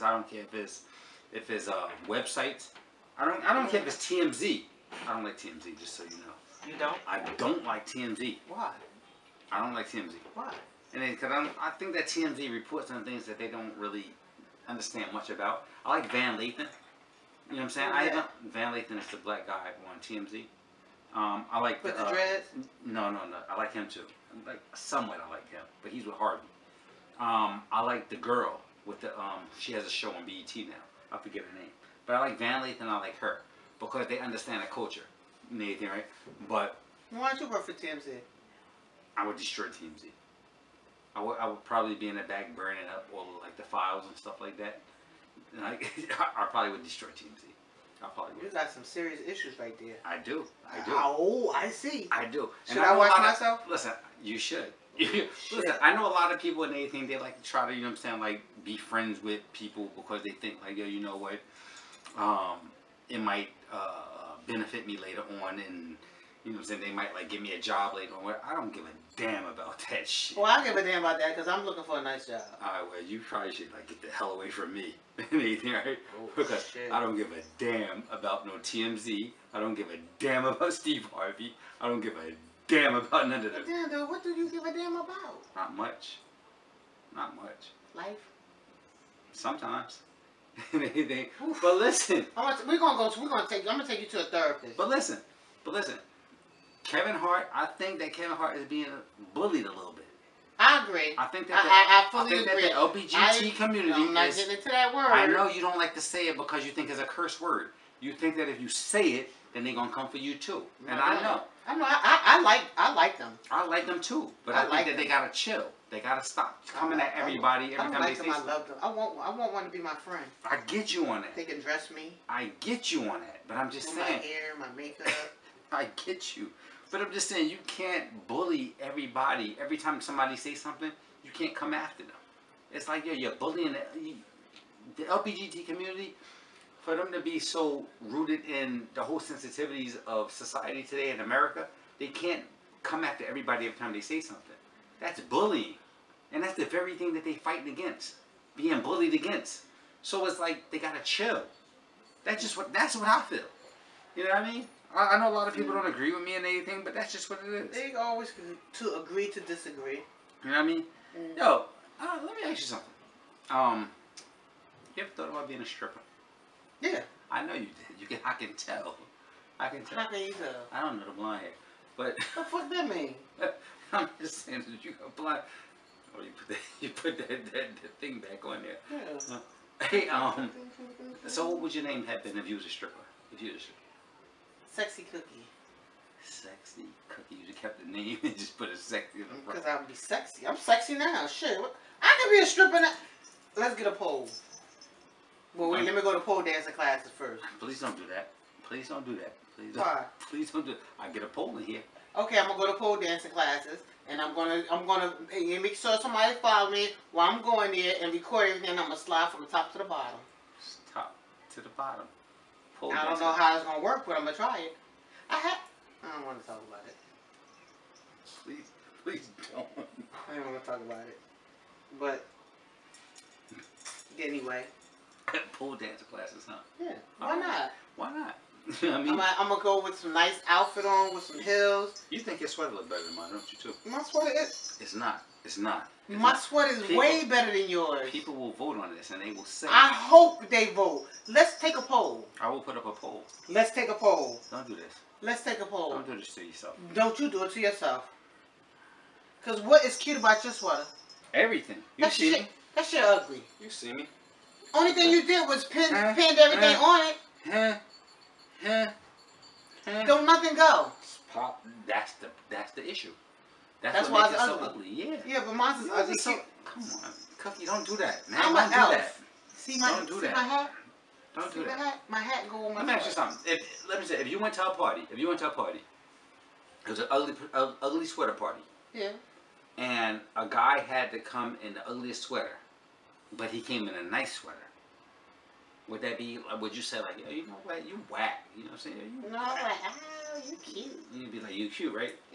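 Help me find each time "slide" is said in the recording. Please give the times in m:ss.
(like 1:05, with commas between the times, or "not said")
3:28.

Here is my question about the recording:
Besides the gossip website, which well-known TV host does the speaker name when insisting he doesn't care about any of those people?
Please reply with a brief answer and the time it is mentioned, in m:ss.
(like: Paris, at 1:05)
Steve Harvey, at 1:20.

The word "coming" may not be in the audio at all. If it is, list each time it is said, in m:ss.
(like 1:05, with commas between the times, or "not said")
1:56.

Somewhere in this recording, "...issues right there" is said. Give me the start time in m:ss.
0:49.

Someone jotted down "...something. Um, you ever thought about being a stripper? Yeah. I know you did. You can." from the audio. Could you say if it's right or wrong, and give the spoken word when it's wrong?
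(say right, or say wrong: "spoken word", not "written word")
right.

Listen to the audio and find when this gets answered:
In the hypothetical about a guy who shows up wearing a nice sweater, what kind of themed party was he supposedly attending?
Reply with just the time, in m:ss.
4:37.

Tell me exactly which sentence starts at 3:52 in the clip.
You think your sweater looks better than mine, don't you?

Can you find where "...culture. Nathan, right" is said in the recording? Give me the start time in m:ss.
0:34.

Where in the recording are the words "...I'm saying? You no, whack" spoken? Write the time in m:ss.
4:48.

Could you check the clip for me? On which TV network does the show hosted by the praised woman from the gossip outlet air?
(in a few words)
BET.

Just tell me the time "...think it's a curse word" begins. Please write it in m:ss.
1:46.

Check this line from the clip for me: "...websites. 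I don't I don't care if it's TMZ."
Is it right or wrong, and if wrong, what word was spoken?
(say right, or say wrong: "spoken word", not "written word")
right.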